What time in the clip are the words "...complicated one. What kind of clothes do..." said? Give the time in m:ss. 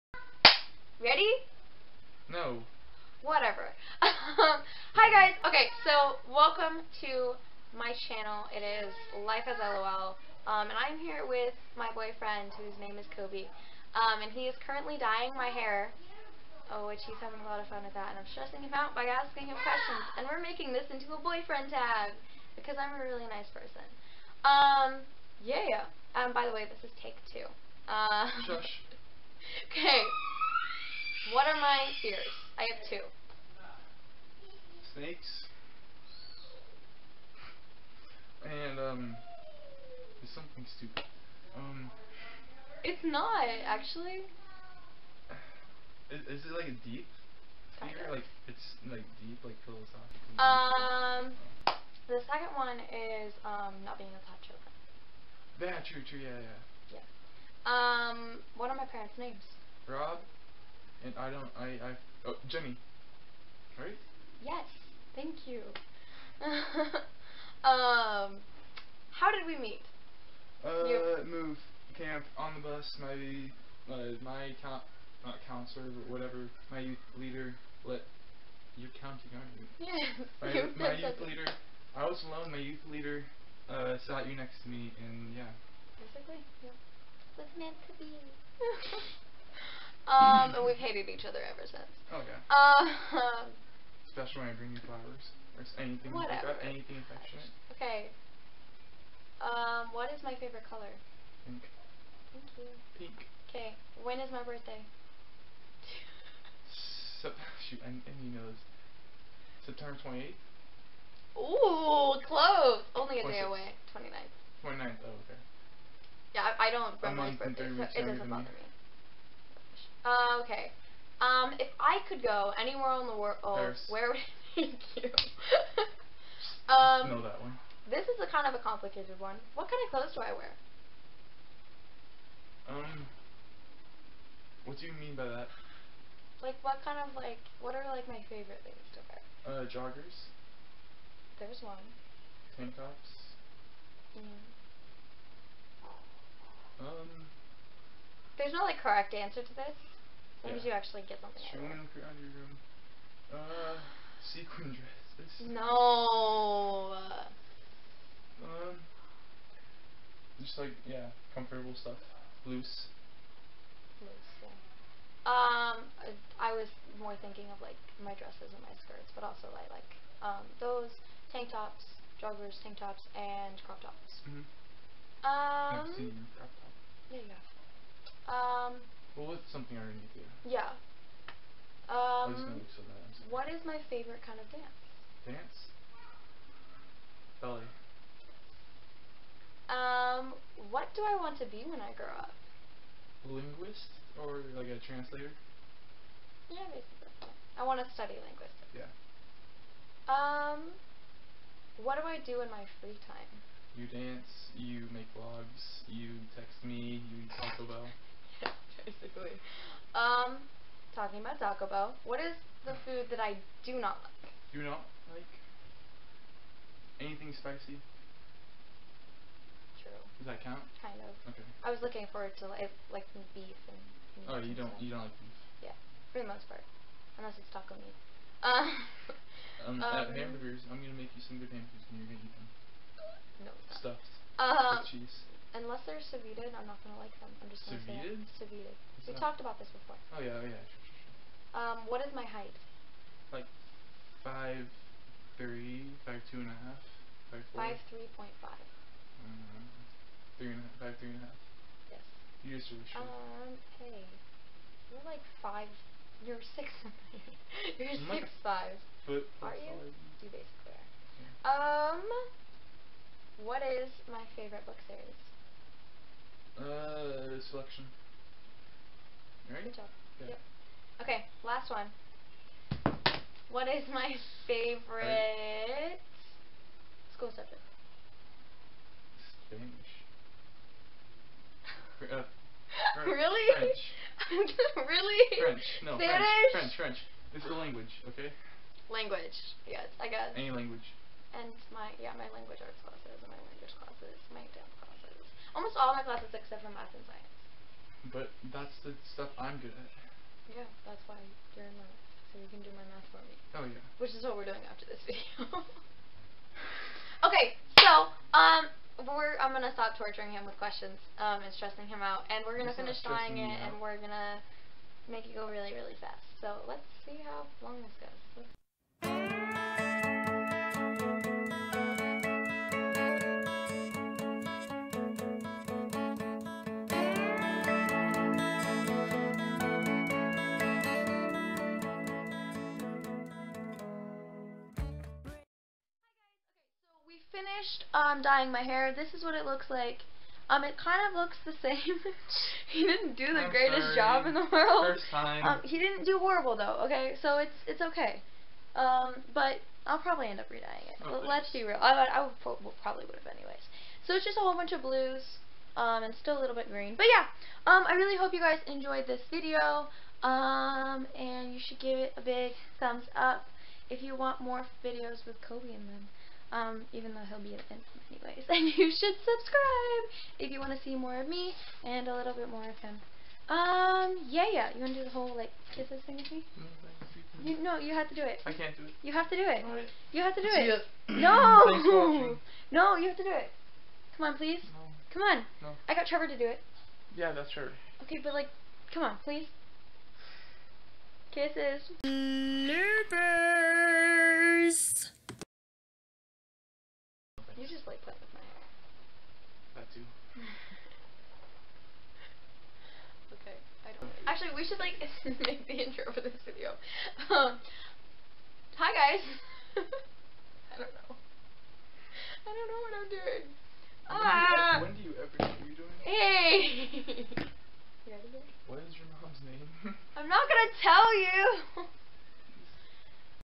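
2:08.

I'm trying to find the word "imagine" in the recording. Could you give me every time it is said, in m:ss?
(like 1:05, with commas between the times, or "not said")
not said.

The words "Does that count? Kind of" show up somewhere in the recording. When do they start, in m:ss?
3:40.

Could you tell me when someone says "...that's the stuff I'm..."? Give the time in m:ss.
4:58.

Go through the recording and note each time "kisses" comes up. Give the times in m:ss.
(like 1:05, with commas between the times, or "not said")
6:15, 6:31.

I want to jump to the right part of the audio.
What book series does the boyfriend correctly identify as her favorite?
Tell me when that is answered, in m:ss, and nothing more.
4:27.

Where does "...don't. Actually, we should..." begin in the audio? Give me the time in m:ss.
6:43.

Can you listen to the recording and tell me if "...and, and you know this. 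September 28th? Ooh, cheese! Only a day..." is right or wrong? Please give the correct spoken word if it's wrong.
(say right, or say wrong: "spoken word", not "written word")
wrong: "close", not "cheese".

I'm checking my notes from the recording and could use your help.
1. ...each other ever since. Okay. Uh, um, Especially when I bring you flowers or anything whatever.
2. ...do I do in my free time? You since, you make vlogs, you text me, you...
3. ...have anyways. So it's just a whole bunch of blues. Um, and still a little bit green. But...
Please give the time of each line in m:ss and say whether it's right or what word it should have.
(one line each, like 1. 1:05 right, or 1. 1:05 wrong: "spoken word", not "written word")
1. 1:31 right
2. 3:21 wrong: "dance", not "since"
3. 5:53 right.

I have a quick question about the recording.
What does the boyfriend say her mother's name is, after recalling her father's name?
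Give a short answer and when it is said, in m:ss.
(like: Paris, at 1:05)
Jenny, at 1:02.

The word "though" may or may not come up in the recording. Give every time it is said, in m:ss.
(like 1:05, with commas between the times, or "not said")
5:46, 6:07.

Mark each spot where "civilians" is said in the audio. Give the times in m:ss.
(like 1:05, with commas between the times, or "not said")
not said.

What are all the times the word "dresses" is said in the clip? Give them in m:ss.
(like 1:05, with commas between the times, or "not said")
2:34, 2:48.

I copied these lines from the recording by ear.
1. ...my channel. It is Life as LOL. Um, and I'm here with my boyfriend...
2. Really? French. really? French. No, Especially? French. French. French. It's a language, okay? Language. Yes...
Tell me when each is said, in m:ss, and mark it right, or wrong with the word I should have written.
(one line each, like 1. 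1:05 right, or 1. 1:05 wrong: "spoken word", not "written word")
1. 0:07 right
2. 4:43 wrong: "Spanish", not "Especially".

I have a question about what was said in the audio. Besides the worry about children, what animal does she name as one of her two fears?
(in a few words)
Snakes.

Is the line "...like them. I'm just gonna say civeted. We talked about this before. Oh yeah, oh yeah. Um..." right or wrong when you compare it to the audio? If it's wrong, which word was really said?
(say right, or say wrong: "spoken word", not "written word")
right.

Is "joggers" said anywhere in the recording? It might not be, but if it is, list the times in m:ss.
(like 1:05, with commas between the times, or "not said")
2:19, 2:52.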